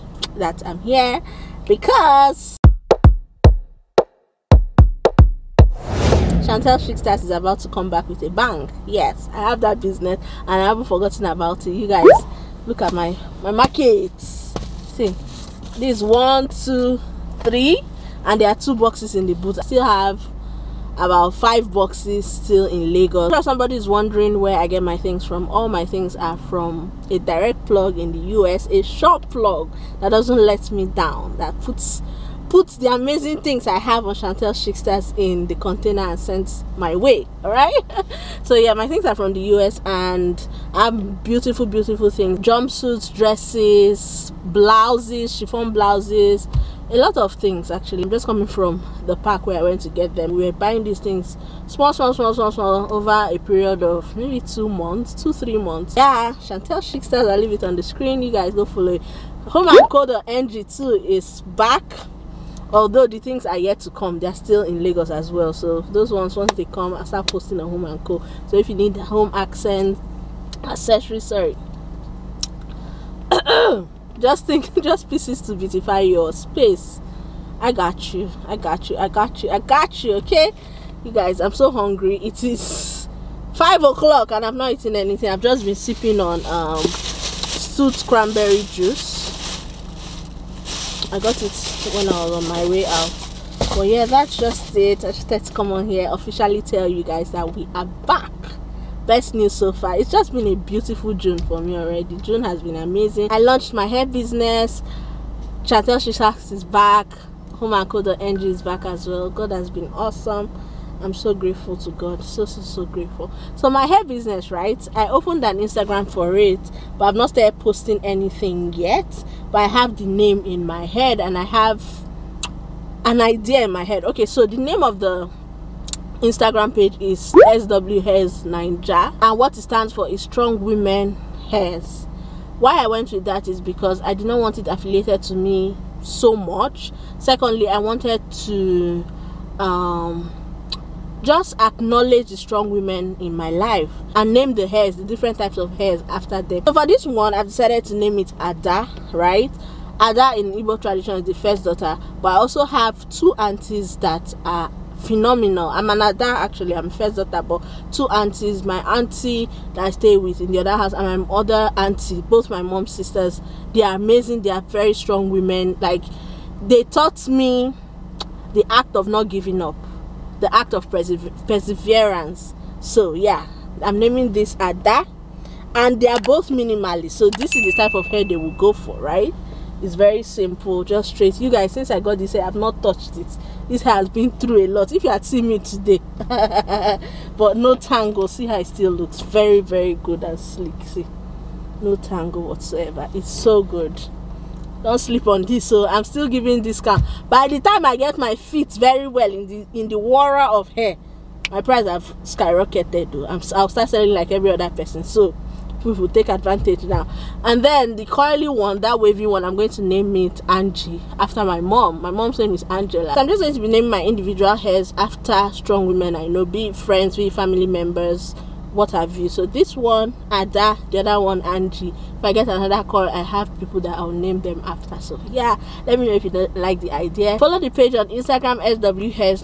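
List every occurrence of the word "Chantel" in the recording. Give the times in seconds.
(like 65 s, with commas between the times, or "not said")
6 s, 34 s, 56 s, 105 s.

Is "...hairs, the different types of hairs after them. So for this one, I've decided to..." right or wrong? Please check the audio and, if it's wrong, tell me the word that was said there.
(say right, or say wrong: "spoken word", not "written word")
right.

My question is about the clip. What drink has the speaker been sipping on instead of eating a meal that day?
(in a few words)
stewed cranberry juice.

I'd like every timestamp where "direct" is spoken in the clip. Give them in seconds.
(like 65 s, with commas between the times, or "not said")
27 s.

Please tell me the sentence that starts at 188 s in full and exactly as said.
See how it still looks very, very good and sleek.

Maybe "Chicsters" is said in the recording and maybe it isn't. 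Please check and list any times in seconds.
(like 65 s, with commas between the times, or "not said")
6 s, 34 s, 56 s.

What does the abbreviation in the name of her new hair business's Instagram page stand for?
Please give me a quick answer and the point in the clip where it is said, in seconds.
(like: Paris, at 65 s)
Strong Women Hairs, at 130 s.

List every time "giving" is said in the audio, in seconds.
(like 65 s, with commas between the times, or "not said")
169 s, 196 s.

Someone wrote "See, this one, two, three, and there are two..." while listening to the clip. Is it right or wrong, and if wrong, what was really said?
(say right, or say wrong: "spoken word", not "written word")
right.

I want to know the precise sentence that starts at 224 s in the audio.
So yeah, let me know if you like the idea.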